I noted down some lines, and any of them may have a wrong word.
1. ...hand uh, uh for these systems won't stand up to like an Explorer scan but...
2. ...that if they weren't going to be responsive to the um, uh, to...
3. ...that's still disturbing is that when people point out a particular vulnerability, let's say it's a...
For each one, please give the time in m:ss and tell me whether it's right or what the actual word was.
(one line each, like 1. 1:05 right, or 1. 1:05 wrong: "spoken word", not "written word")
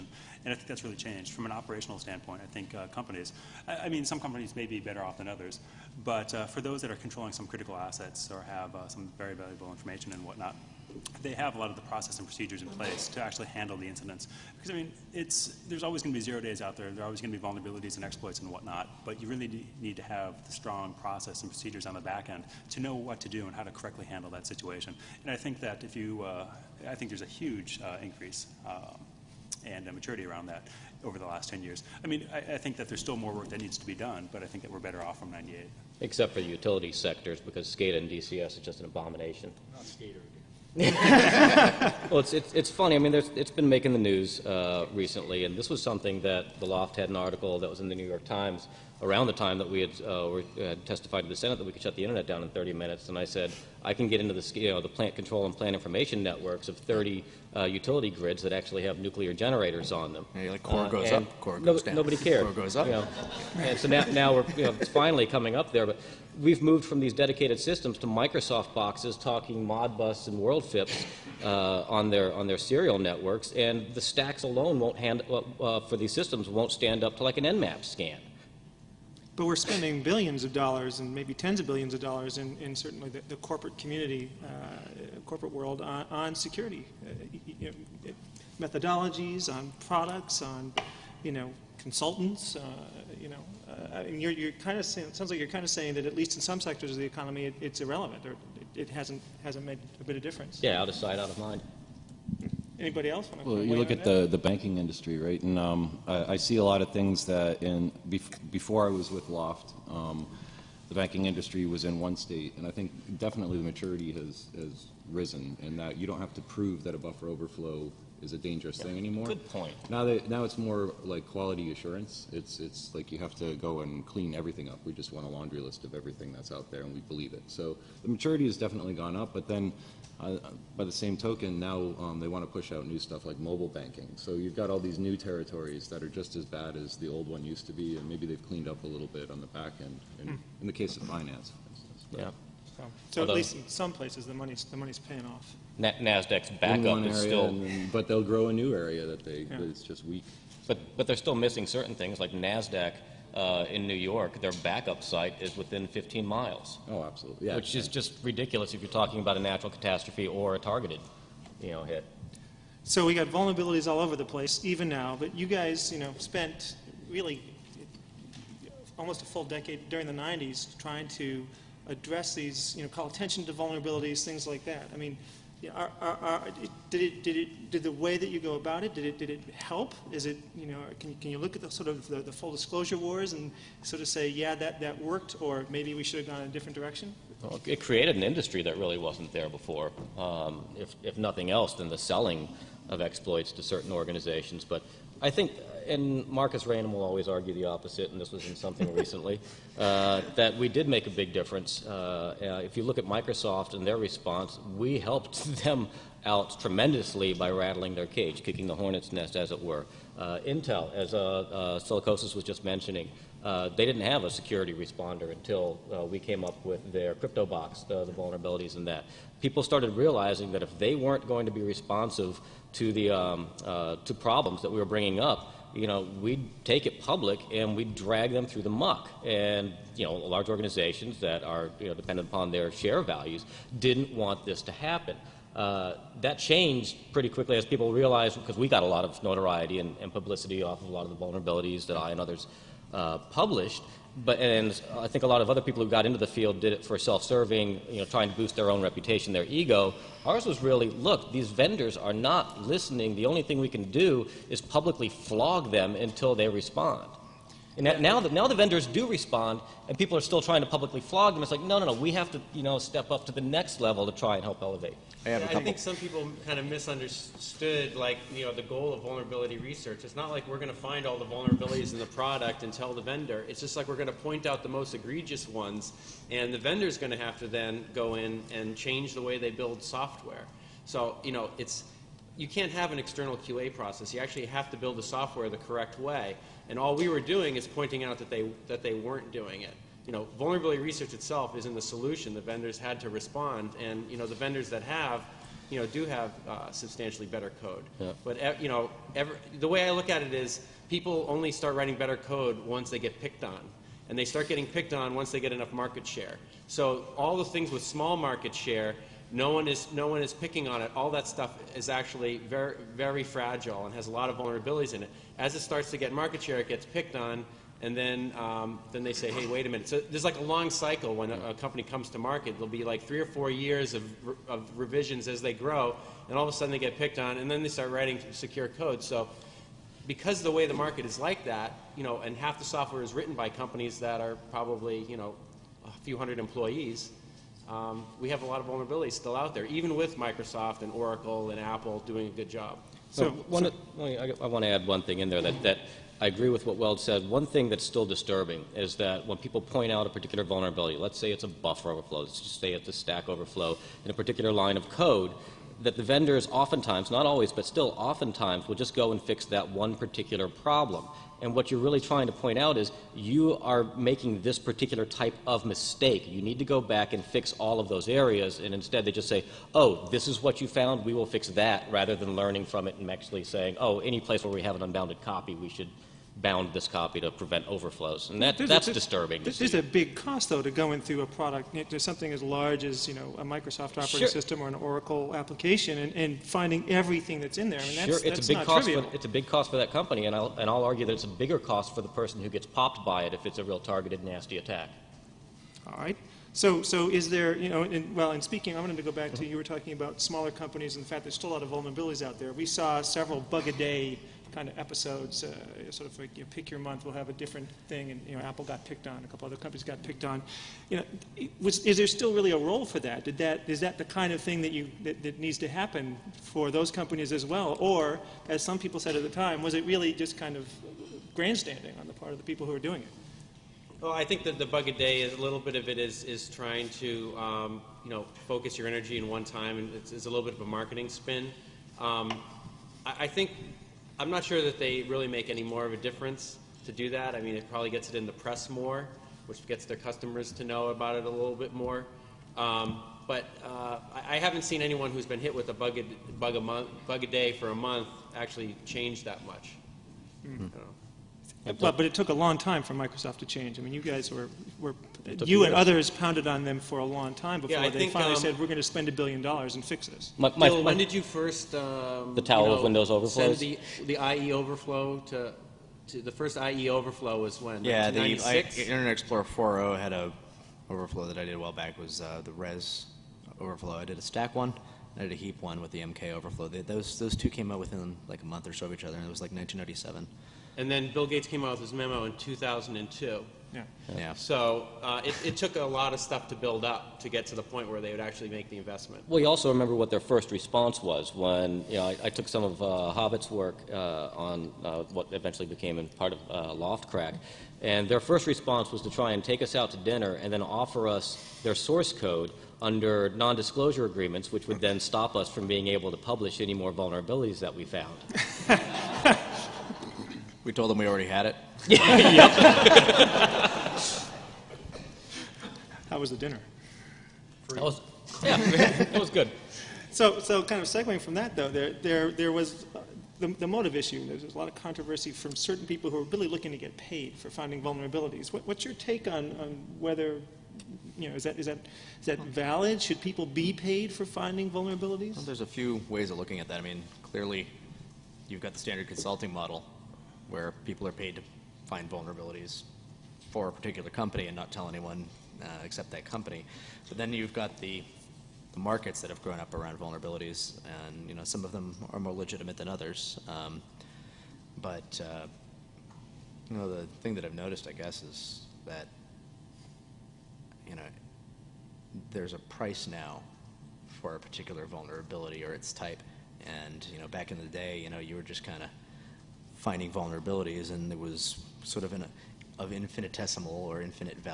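1. 1:14 wrong: "Nmap", not "Explorer"
2. 3:40 right
3. 5:47 right.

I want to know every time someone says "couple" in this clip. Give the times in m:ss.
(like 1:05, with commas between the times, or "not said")
4:25, 6:49.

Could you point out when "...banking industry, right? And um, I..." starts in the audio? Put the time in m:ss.
1:44.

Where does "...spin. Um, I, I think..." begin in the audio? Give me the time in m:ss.
7:11.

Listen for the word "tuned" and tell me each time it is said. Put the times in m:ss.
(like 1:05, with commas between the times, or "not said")
not said.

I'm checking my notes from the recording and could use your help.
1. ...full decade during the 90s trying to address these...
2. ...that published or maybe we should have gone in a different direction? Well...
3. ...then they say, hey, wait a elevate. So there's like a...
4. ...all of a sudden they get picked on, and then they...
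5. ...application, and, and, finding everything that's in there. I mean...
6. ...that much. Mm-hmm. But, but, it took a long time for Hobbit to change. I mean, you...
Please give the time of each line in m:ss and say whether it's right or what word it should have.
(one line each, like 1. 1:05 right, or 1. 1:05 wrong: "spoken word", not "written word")
1. 2:49 right
2. 3:04 wrong: "worked", not "published"
3. 5:18 wrong: "minute", not "elevate"
4. 5:26 right
5. 6:25 right
6. 7:29 wrong: "Microsoft", not "Hobbit".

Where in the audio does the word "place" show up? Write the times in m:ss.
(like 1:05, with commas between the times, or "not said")
0:12, 2:23, 2:44, 6:14.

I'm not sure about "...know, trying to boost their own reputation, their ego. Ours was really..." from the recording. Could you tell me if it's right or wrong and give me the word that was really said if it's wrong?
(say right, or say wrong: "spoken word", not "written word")
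right.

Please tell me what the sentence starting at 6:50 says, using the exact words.
You know, was, is there still really a role for that?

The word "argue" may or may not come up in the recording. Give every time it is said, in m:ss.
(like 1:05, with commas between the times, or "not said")
3:17, 6:30.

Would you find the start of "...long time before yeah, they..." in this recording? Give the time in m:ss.
7:37.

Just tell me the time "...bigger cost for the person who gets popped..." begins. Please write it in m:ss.
6:31.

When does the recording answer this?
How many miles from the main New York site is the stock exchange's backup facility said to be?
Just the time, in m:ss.
2:35.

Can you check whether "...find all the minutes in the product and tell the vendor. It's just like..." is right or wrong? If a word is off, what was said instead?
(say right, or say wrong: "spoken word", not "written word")
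wrong: "vulnerabilities", not "minutes".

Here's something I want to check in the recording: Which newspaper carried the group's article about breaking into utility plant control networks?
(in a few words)
New York Times.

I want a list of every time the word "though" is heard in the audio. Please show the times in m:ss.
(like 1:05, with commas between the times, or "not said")
6:20, 8:41.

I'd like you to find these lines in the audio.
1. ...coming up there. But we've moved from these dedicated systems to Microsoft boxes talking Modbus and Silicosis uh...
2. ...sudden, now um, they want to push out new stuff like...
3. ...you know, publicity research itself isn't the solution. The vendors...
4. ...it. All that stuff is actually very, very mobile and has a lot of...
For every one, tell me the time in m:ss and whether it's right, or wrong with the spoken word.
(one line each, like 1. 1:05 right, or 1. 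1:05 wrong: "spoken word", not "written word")
1. 1:05 wrong: "WorldFIPs", not "Silicosis"
2. 2:11 wrong: "token", not "sudden"
3. 4:50 wrong: "vulnerability", not "publicity"
4. 5:10 wrong: "fragile", not "mobile".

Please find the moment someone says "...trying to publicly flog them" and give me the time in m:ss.
4:20.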